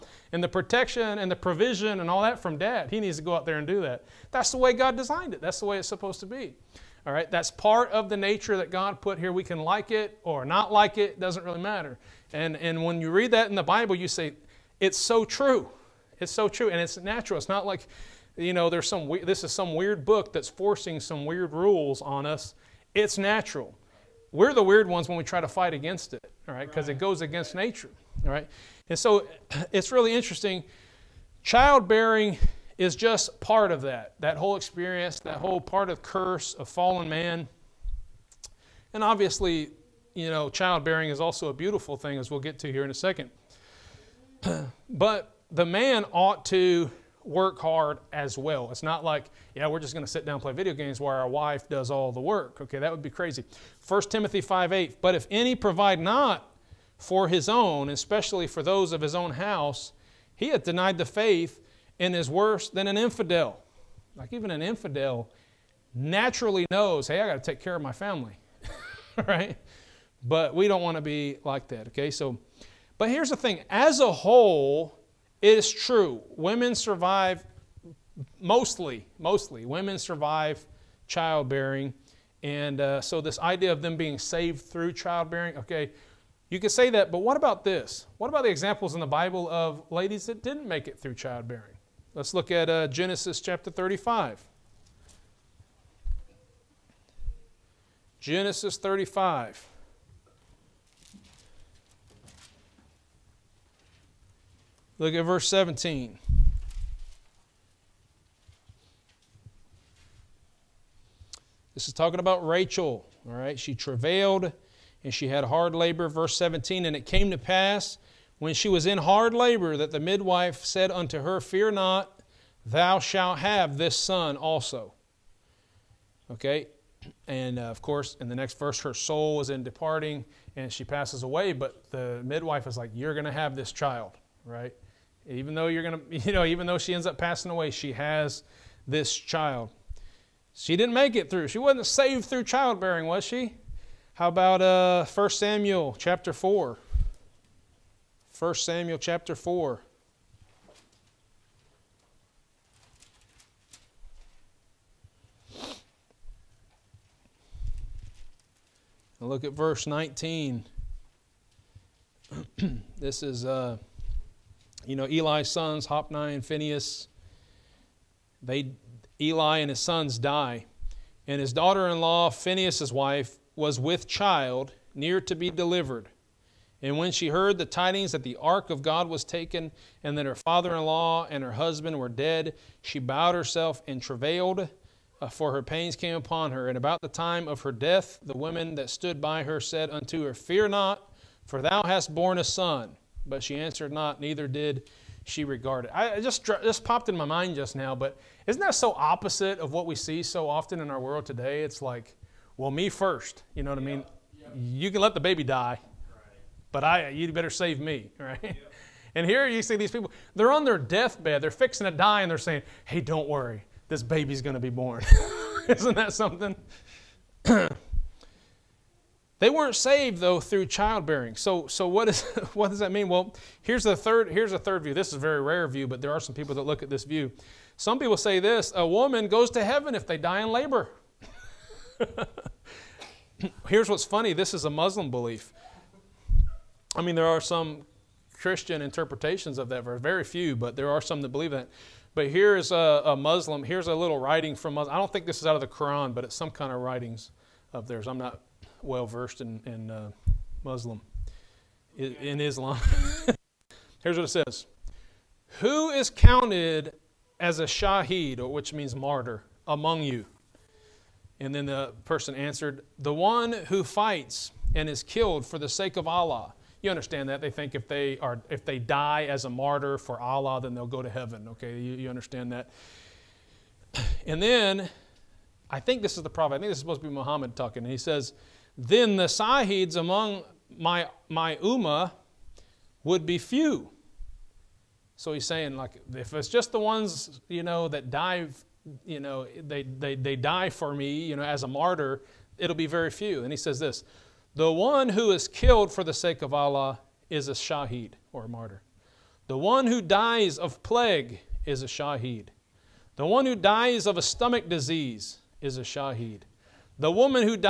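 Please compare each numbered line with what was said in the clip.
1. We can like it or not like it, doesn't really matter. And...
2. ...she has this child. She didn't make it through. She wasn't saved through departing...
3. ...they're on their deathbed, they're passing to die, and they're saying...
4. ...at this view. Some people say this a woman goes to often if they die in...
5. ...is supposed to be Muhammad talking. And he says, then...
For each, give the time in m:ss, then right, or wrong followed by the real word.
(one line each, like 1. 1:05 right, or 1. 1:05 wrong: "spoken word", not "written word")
1. 0:09 right
2. 2:17 wrong: "childbearing", not "departing"
3. 3:30 wrong: "fixing", not "passing"
4. 3:46 wrong: "heaven", not "often"
5. 4:36 right.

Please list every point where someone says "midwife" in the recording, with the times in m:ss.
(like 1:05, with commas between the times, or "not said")
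1:59, 2:12.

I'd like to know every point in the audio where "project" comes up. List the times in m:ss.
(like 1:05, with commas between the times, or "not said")
not said.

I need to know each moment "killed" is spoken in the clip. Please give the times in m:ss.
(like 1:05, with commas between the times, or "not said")
4:25, 4:55.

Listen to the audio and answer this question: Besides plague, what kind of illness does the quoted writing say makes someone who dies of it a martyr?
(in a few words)
Stomach disease.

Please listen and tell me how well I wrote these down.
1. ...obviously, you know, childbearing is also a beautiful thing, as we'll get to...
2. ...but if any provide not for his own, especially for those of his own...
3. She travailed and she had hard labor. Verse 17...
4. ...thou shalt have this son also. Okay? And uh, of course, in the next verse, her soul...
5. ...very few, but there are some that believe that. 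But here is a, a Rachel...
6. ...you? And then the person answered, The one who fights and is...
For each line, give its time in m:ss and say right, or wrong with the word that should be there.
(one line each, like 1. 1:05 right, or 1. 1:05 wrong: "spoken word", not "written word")
1. 0:39 right
2. 0:55 right
3. 1:53 right
4. 2:02 right
5. 4:00 wrong: "Muslim", not "Rachel"
6. 4:20 right.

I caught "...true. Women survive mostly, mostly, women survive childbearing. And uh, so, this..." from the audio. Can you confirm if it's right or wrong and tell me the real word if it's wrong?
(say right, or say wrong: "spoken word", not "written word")
right.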